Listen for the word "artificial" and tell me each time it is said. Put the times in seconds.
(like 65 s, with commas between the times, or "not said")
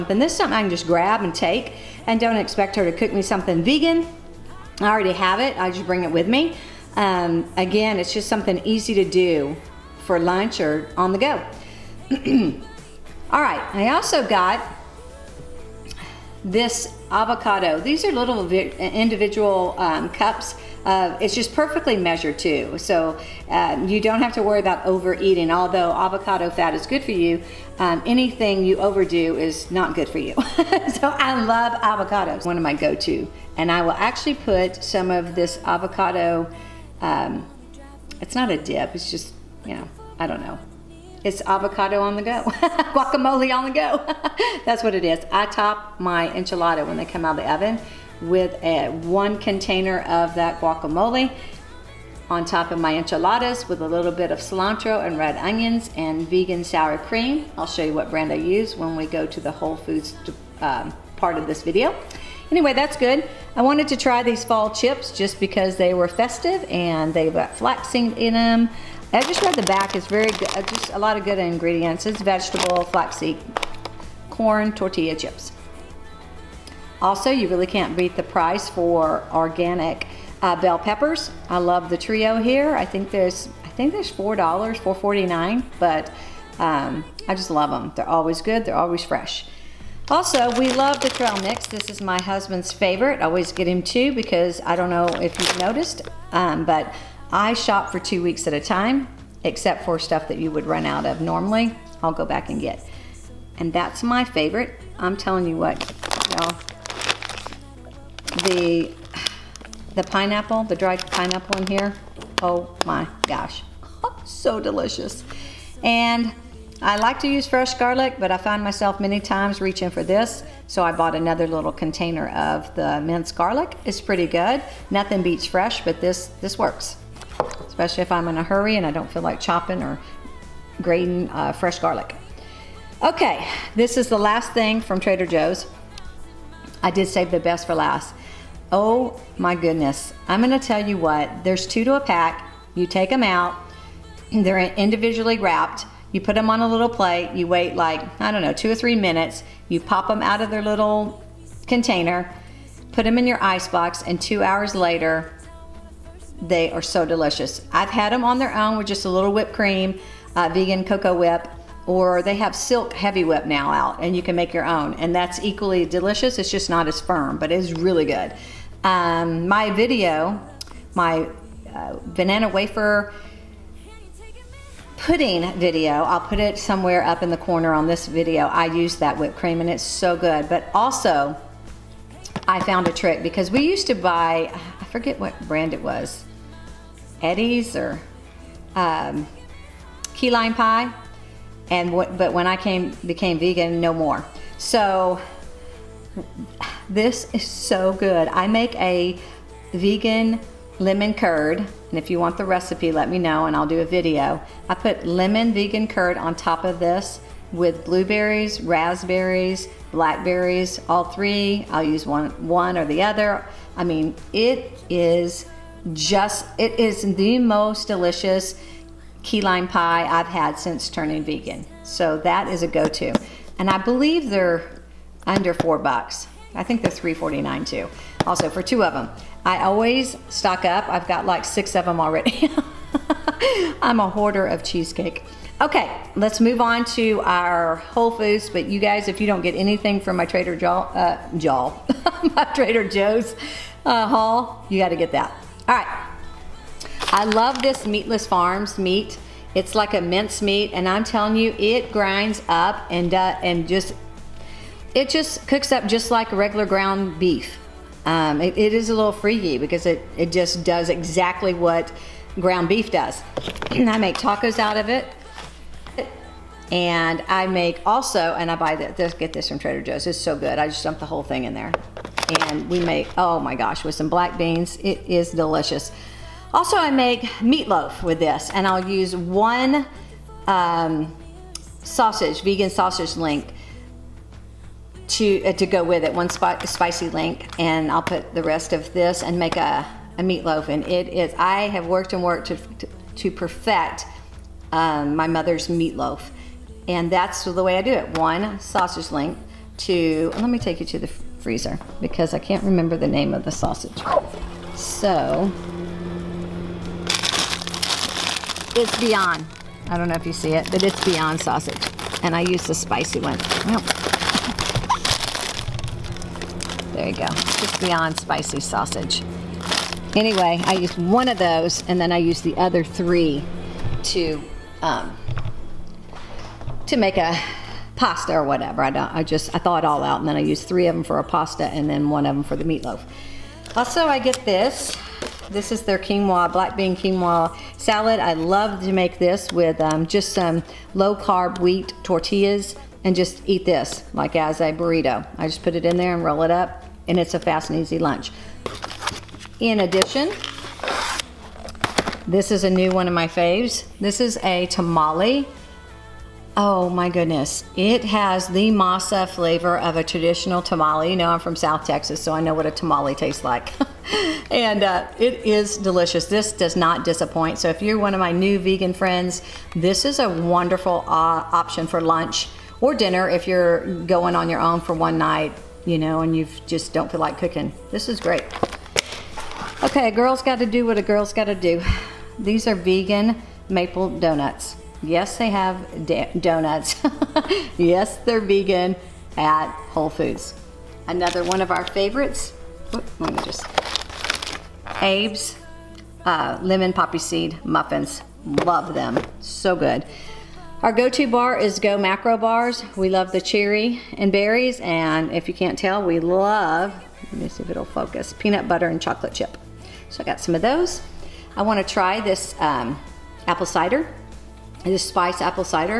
not said.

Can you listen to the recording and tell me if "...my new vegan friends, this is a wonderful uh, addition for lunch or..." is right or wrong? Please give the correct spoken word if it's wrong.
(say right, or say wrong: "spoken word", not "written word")
wrong: "option", not "addition".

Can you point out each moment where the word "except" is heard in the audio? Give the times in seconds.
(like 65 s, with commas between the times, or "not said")
99 s.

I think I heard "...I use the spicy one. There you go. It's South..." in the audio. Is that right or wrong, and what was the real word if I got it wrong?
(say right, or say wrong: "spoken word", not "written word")
wrong: "Beyond", not "South".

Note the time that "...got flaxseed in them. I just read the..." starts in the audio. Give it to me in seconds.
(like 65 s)
67 s.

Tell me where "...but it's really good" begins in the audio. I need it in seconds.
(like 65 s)
167 s.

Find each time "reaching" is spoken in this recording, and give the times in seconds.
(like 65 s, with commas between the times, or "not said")
119 s.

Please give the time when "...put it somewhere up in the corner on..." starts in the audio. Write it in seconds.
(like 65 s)
176 s.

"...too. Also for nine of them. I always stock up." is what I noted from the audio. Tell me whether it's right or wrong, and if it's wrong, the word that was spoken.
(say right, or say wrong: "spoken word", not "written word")
wrong: "two", not "nine".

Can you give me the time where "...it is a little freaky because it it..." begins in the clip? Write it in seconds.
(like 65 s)
258 s.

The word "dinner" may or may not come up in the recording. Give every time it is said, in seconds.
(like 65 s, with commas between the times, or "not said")
372 s.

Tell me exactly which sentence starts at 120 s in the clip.
So I bought another little container of the minced garlic.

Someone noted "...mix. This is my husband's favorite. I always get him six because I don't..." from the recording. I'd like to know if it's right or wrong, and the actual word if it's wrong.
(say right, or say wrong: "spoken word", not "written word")
wrong: "two", not "six".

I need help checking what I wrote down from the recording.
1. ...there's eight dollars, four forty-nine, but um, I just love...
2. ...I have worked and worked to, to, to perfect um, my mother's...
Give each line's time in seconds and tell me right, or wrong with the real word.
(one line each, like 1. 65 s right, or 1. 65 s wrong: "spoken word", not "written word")
1. 83 s wrong: "four", not "eight"
2. 291 s right.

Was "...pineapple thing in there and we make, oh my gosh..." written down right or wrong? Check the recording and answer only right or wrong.
wrong.